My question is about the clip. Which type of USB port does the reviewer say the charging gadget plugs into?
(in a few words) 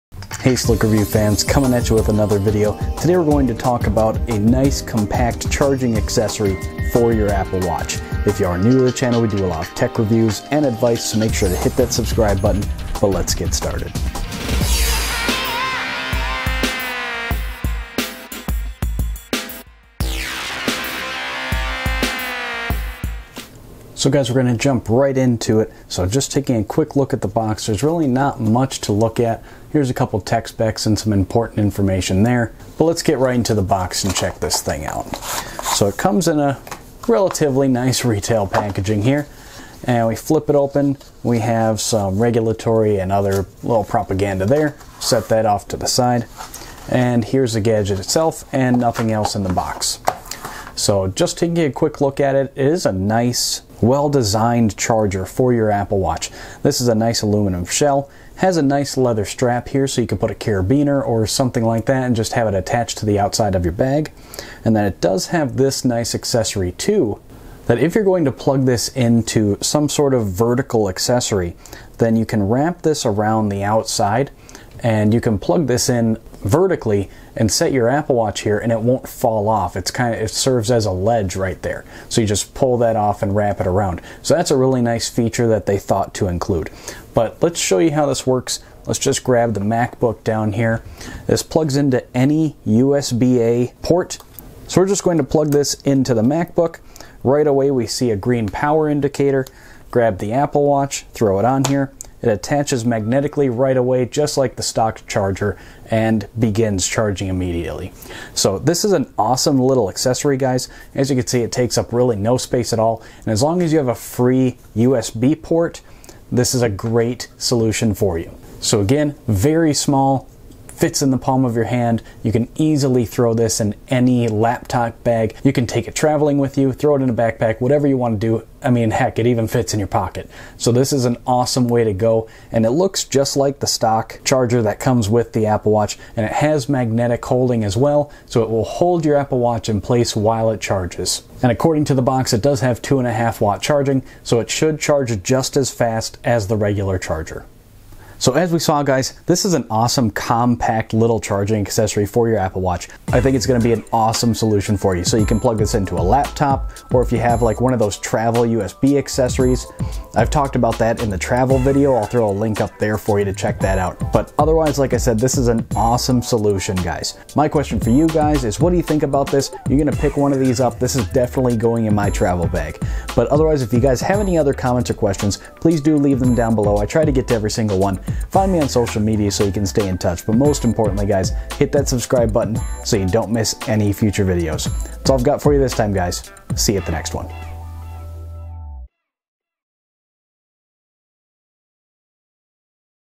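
USB-A.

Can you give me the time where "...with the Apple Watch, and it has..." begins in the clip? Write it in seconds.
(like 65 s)
135 s.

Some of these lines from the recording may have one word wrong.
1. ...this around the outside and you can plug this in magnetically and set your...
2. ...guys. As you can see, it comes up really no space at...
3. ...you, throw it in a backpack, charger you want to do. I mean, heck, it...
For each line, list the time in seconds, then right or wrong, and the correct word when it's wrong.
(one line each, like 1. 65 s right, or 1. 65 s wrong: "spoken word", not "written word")
1. 72 s wrong: "vertically", not "magnetically"
2. 110 s wrong: "takes", not "comes"
3. 126 s wrong: "whatever", not "charger".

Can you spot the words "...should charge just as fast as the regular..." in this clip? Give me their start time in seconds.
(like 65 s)
144 s.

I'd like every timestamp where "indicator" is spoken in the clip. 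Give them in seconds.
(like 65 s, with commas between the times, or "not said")
98 s.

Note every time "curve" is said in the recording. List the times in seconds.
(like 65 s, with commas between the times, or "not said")
not said.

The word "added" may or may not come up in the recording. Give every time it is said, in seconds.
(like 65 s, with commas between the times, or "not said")
not said.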